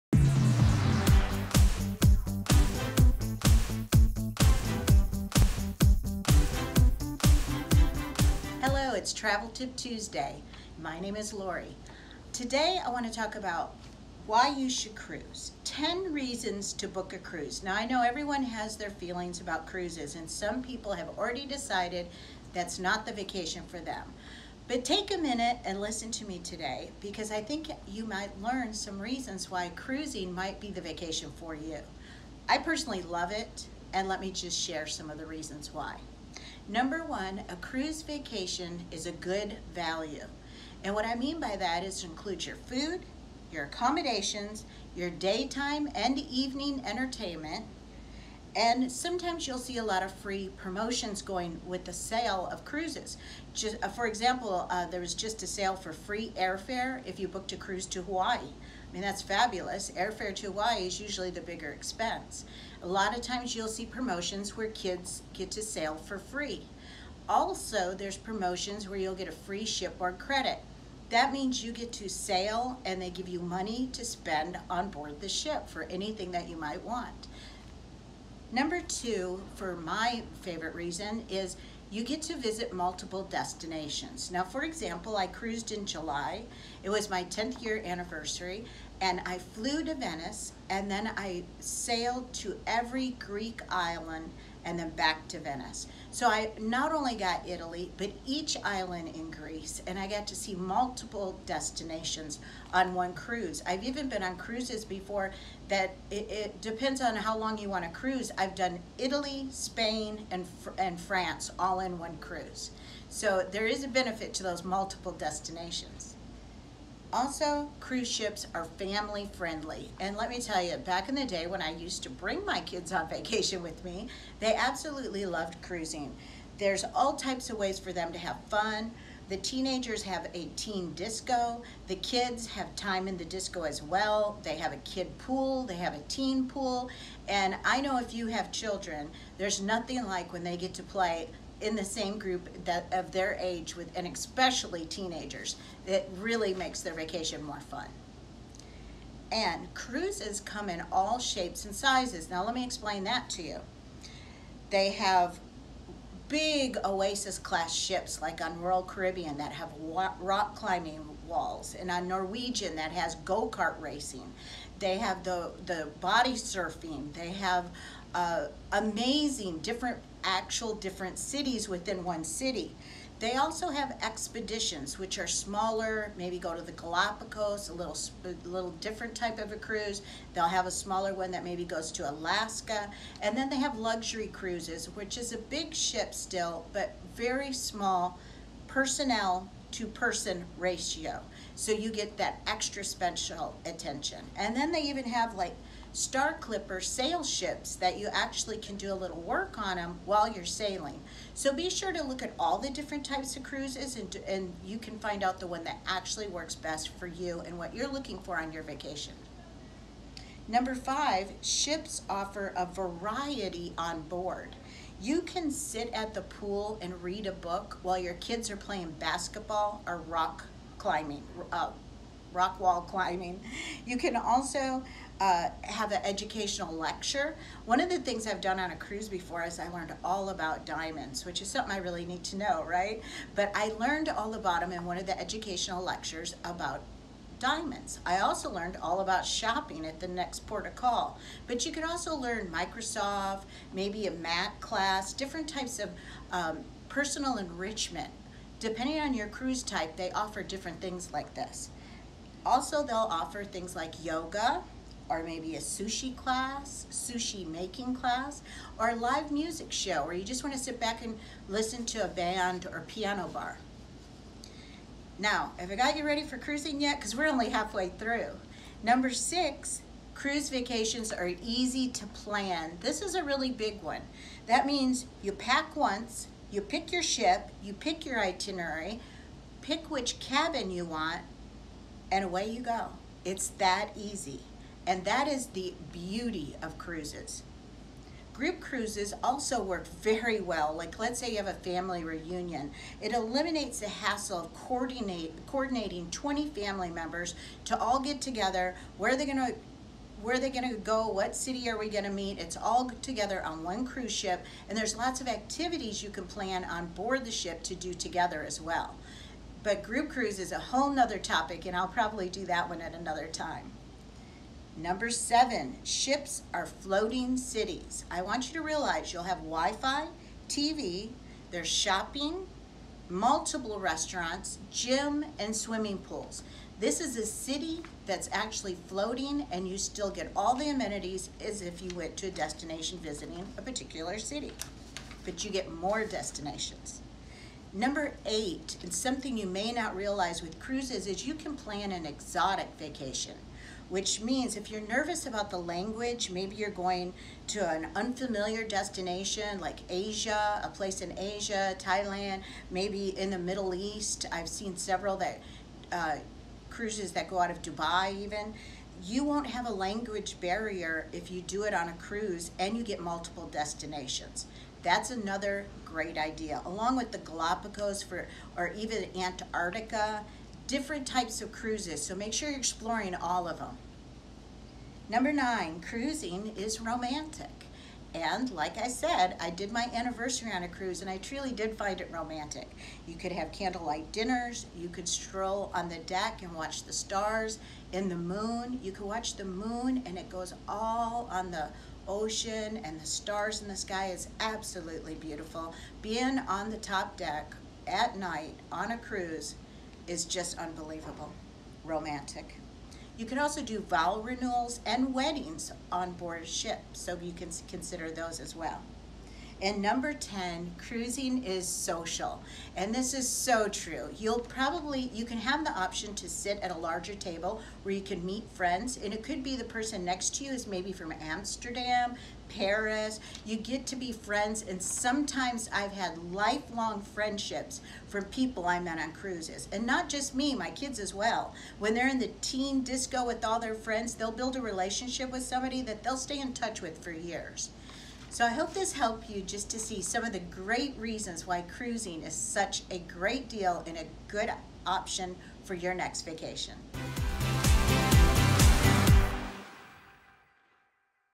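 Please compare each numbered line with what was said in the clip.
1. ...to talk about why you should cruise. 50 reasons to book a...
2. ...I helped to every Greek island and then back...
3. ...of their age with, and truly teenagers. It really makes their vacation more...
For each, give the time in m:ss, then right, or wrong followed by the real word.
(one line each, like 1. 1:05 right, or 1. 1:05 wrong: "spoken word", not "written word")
1. 0:13 wrong: "10", not "50"
2. 1:31 wrong: "sailed", not "helped"
3. 2:22 wrong: "especially", not "truly".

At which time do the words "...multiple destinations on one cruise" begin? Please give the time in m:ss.
1:40.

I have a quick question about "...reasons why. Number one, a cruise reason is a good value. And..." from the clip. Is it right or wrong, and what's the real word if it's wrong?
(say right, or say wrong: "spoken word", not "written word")
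wrong: "vacation", not "reason".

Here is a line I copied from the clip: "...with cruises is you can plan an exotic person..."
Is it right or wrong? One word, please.
wrong.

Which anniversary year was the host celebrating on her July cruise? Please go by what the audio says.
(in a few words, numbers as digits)
10th.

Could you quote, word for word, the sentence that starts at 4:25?
Now, have I got you ready for cruising yet?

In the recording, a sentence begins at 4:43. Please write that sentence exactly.
It's that easy and that is the beauty of cruises.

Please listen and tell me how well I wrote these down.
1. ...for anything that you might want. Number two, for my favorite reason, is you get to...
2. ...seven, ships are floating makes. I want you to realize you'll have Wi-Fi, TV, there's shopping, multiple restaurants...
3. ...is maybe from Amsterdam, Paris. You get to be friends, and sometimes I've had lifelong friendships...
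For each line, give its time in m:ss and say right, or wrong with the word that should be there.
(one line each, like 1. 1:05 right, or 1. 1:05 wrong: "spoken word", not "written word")
1. 1:15 right
2. 5:15 wrong: "cities", not "makes"
3. 7:00 right.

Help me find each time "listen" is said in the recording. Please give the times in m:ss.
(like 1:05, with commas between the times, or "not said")
0:25, 4:21.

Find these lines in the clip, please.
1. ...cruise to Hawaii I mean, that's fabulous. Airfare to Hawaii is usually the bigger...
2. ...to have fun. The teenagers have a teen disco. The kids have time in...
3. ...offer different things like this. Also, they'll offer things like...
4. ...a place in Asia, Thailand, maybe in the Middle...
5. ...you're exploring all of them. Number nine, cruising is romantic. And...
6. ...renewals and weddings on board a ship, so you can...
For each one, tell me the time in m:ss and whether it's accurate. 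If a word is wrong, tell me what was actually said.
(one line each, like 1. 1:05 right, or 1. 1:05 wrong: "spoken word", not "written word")
1. 0:57 right
2. 2:08 right
3. 4:10 right
4. 5:50 right
5. 6:12 right
6. 6:44 right.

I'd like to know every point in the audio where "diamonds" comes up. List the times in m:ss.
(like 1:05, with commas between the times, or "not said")
3:50, 3:57.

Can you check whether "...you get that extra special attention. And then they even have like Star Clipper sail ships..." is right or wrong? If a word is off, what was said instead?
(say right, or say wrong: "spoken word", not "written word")
right.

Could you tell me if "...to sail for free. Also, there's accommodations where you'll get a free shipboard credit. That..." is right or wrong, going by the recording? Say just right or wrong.
wrong.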